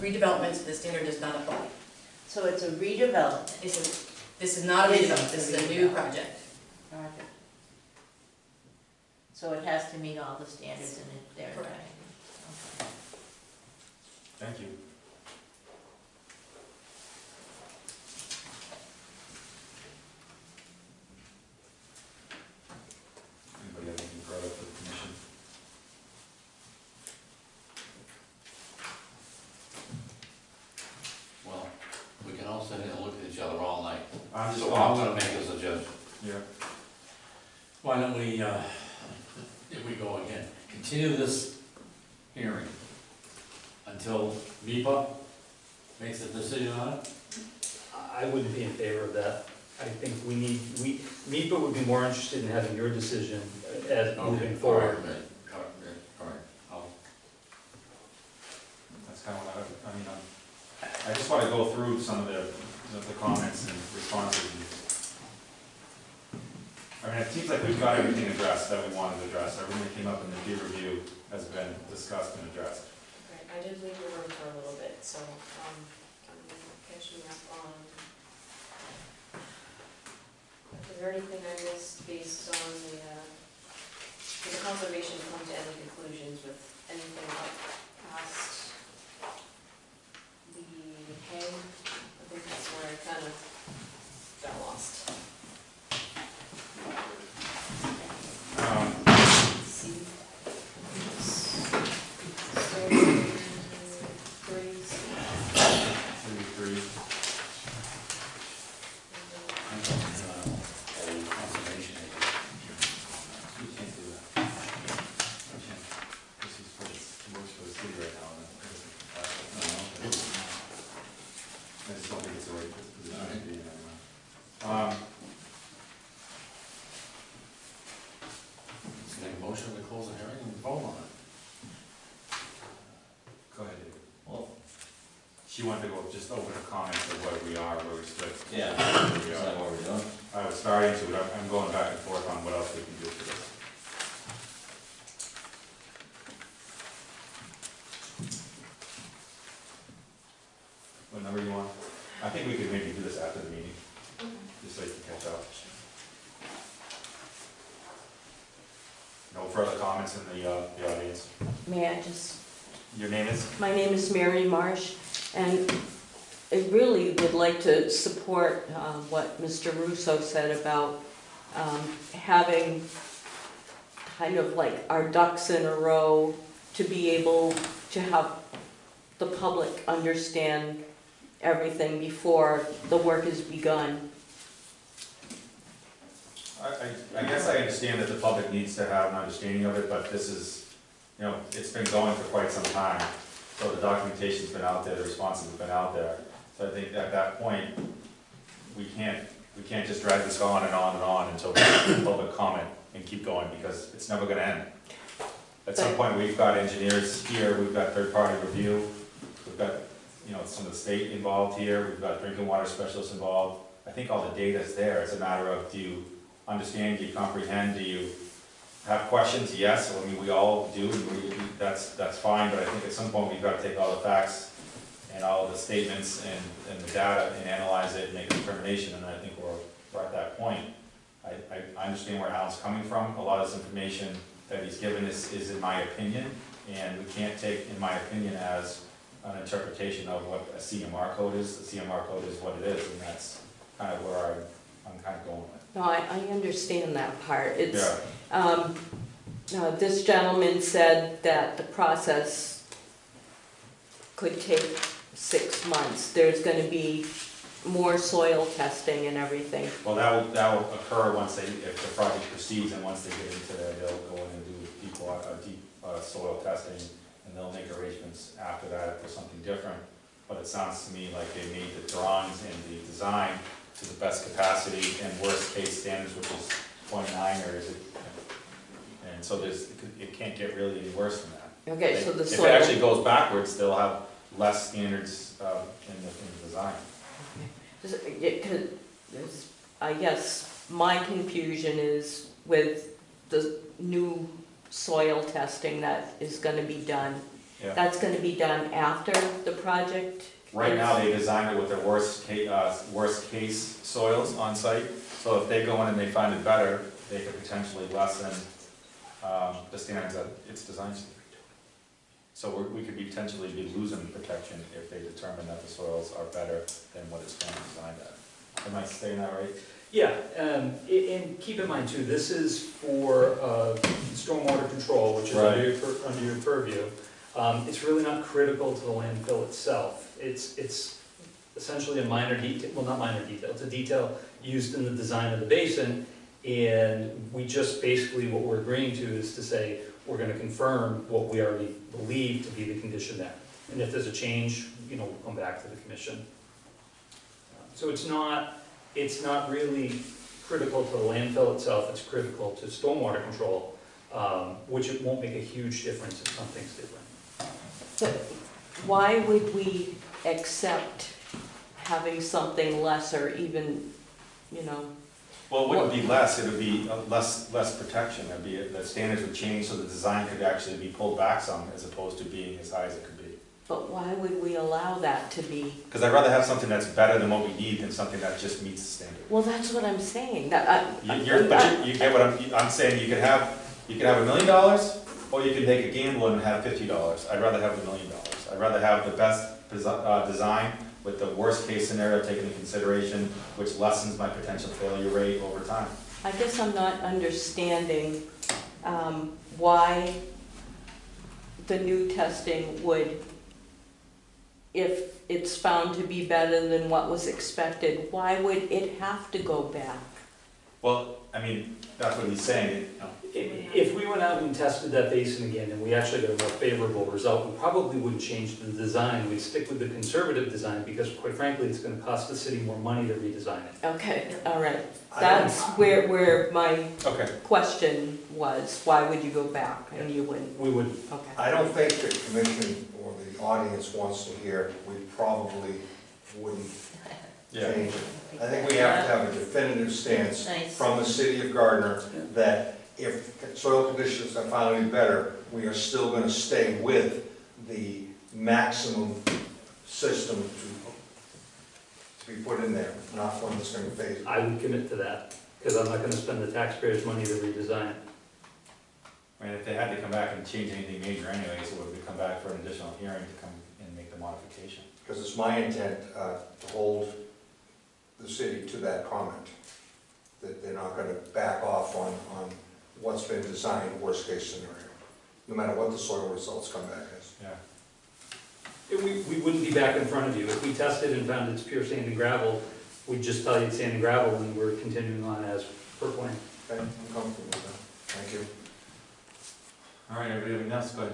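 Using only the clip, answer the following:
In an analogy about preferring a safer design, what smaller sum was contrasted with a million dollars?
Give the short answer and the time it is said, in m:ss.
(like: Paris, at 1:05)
fifty dollars, at 6:26.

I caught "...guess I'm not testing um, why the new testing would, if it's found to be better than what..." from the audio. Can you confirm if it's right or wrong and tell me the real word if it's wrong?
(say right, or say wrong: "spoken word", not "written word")
wrong: "understanding", not "testing".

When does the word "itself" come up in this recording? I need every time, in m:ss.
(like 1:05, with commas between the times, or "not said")
5:29, 5:51.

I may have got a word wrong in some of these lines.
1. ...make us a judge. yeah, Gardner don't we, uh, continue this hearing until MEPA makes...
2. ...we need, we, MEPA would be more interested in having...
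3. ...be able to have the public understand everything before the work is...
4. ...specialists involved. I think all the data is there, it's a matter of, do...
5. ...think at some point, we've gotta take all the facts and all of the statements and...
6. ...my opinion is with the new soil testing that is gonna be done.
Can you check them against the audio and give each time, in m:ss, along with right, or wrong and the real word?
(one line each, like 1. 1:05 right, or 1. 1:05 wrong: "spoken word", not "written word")
1. 0:35 wrong: "Why", not "Gardner"
2. 0:50 right
3. 2:56 right
4. 3:32 right
5. 3:42 right
6. 4:50 wrong: "confusion", not "opinion".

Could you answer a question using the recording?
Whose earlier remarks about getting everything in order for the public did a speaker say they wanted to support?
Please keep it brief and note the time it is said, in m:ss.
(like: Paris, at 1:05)
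Mr. Russo, at 2:49.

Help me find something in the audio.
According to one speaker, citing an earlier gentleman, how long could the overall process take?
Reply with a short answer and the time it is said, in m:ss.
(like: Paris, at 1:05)
six months, at 4:15.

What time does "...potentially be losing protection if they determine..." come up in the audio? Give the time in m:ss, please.
5:12.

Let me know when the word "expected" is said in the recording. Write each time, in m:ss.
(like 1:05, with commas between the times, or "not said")
6:47.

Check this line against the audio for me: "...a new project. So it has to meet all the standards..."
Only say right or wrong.
right.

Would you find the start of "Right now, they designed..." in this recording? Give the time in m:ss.
5:00.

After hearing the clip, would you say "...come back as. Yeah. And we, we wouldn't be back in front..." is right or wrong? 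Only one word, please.
right.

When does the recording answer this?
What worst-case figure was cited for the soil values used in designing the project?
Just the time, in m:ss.
4:36.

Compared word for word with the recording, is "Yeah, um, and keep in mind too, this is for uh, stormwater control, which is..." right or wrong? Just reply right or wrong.
right.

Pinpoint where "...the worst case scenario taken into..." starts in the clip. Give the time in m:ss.
6:31.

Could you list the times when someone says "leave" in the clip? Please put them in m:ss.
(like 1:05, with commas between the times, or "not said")
1:13.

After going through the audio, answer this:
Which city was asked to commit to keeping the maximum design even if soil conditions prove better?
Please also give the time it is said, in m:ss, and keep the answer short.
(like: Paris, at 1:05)
Gardner, at 7:21.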